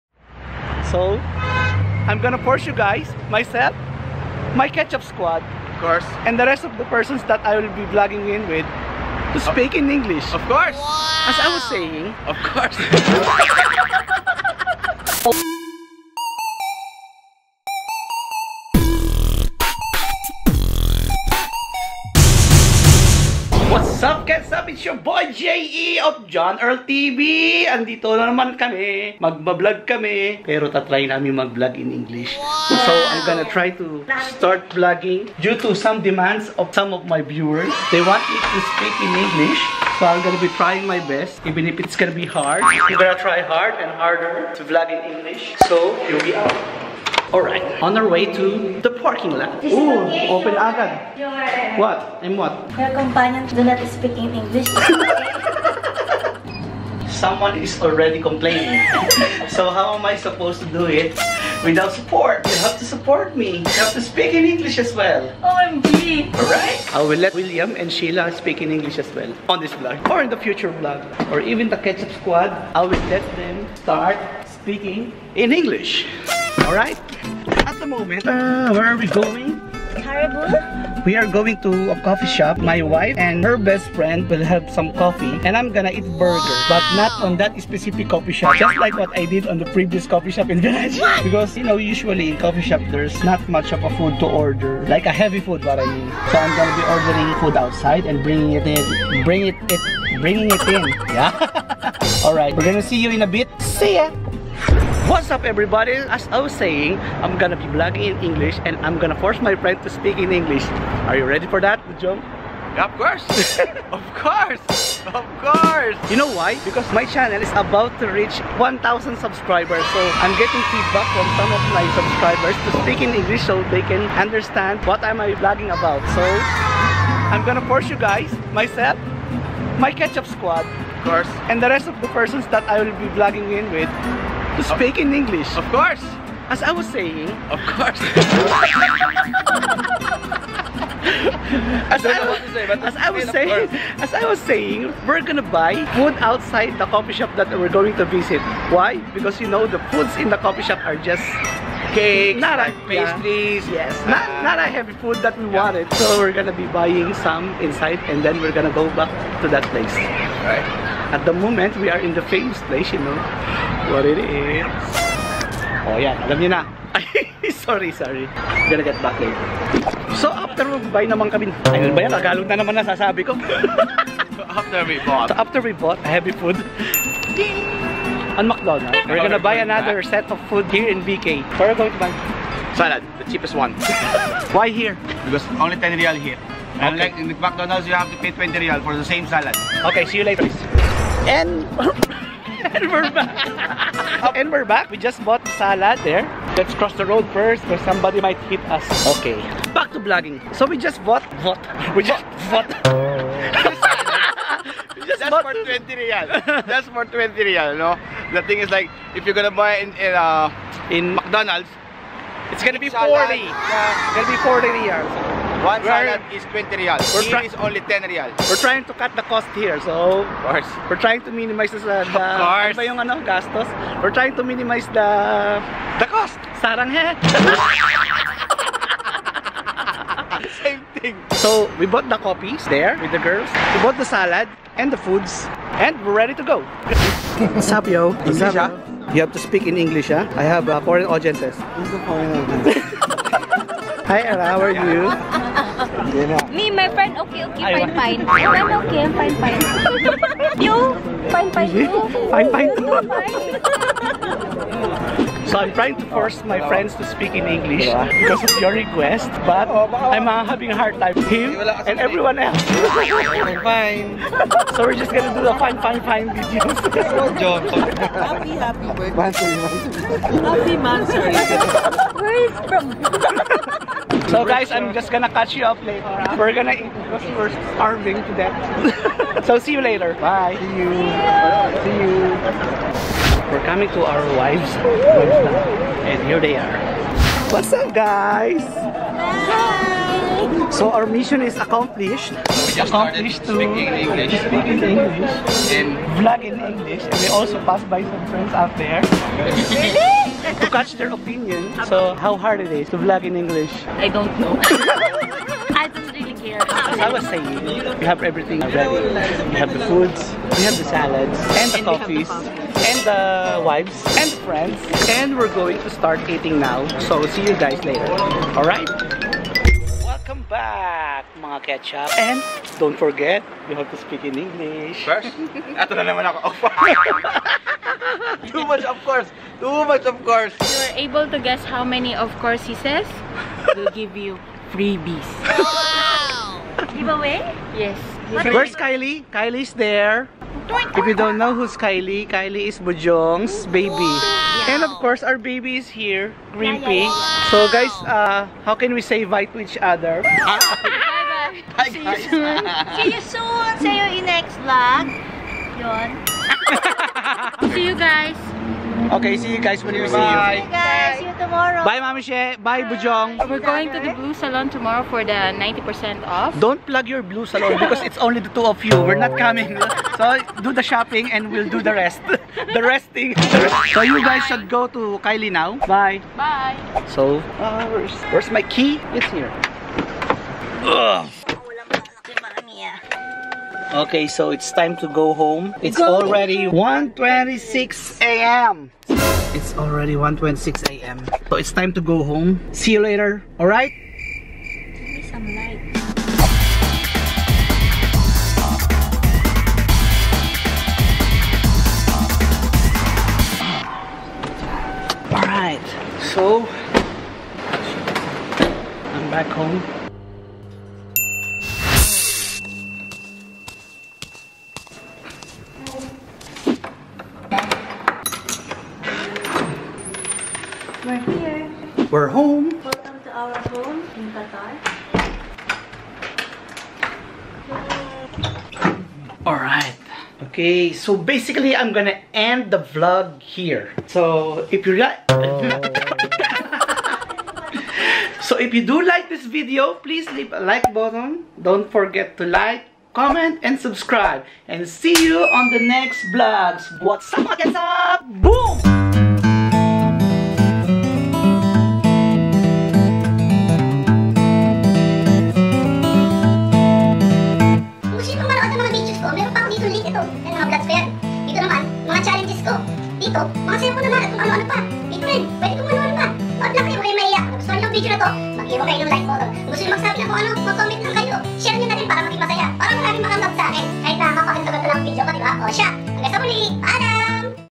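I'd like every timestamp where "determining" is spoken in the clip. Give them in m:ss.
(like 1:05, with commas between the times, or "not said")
not said.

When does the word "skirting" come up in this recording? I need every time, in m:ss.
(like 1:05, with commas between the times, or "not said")
not said.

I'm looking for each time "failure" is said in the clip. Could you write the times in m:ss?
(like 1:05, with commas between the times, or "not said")
not said.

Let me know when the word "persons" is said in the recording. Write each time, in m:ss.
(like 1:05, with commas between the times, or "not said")
0:06, 2:12.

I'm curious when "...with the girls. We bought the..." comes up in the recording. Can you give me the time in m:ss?
3:52.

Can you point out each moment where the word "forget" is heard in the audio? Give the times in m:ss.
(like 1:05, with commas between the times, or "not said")
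5:22, 7:21.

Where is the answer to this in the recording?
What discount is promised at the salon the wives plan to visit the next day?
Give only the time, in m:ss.
6:05.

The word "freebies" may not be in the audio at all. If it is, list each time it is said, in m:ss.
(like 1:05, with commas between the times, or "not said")
5:34.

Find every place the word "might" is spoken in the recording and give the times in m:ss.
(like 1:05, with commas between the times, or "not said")
3:18.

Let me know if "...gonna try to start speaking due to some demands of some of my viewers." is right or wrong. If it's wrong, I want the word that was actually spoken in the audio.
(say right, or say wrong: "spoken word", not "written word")
wrong: "vlogging", not "speaking".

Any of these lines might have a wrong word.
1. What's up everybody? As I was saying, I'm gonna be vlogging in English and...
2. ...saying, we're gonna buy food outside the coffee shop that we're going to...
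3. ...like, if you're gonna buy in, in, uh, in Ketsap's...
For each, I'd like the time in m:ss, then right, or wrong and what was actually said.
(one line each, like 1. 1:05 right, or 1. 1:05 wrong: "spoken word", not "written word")
1. 1:45 right
2. 2:24 right
3. 3:28 wrong: "McDonald", not "Ketsap".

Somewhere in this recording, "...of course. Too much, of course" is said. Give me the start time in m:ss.
5:28.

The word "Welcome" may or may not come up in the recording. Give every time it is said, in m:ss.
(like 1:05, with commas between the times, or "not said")
5:20, 7:02.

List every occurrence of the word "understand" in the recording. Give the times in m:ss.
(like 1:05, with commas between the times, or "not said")
2:04.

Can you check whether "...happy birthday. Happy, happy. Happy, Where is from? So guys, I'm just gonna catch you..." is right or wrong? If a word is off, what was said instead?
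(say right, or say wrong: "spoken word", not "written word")
right.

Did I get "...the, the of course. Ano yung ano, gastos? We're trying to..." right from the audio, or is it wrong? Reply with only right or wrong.
right.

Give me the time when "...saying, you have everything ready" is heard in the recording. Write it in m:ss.
5:07.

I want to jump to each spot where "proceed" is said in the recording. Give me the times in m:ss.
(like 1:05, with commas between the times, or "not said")
not said.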